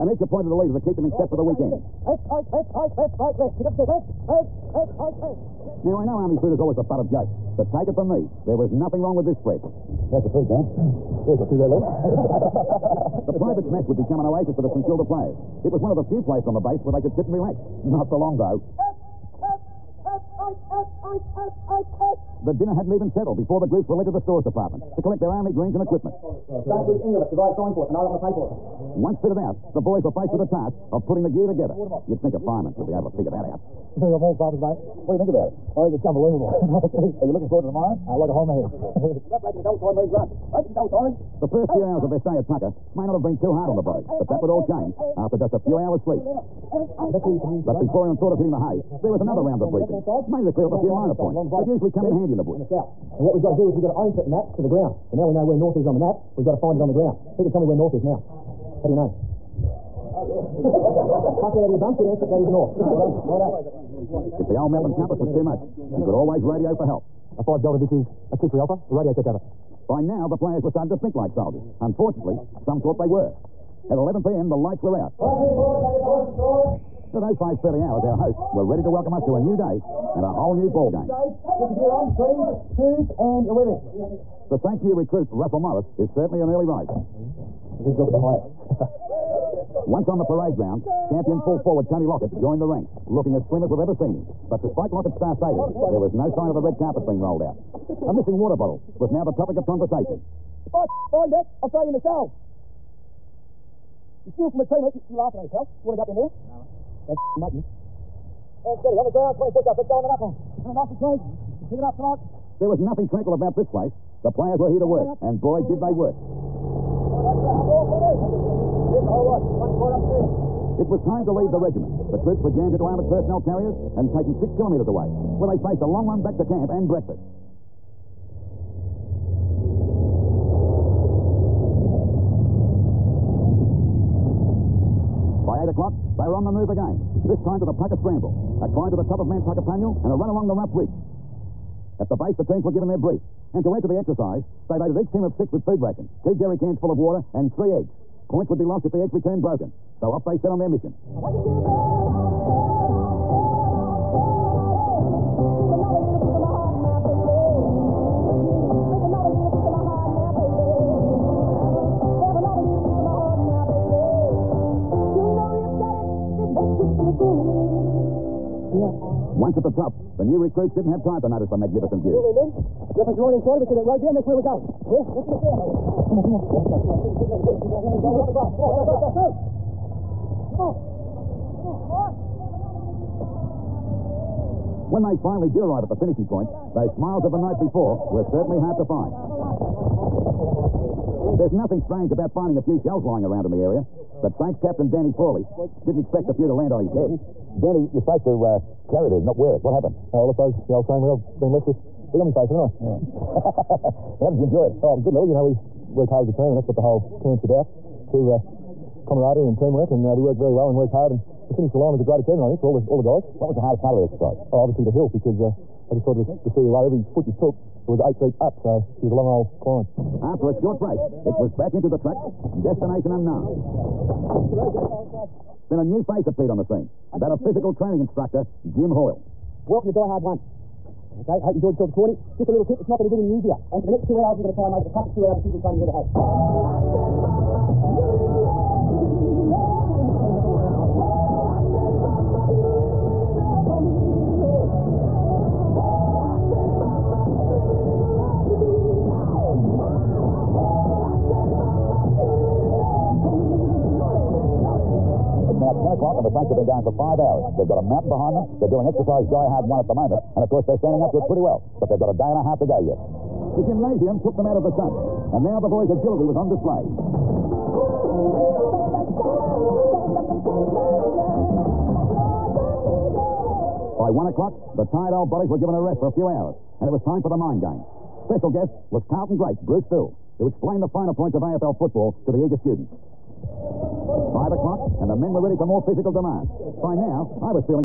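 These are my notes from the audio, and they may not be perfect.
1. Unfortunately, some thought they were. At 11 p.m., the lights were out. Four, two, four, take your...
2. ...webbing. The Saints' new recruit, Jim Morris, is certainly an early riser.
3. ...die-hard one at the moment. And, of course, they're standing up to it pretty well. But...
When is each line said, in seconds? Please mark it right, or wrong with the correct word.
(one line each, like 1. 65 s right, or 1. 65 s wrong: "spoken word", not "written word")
1. 71 s wrong: "Five", not "Four"
2. 83 s wrong: "Russell", not "Jim"
3. 259 s right.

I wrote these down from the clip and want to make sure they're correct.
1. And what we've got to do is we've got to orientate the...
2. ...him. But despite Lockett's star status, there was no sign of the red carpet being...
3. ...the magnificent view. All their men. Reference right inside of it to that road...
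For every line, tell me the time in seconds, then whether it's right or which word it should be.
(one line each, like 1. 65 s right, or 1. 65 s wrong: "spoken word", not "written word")
1. 52 s right
2. 94 s right
3. 171 s right.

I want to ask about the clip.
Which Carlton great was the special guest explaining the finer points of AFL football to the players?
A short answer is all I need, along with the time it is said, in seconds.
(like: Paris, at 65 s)
Bruce Still, at 279 s.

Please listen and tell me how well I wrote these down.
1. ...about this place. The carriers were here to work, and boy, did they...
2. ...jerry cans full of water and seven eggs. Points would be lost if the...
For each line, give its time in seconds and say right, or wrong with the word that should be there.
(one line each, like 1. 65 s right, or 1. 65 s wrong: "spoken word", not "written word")
1. 113 s wrong: "players", not "carriers"
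2. 146 s wrong: "three", not "seven".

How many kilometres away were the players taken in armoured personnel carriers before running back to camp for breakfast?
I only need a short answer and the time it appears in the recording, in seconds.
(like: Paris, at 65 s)
6, at 124 s.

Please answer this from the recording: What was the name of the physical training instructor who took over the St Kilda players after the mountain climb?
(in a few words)
Jim Hoyle.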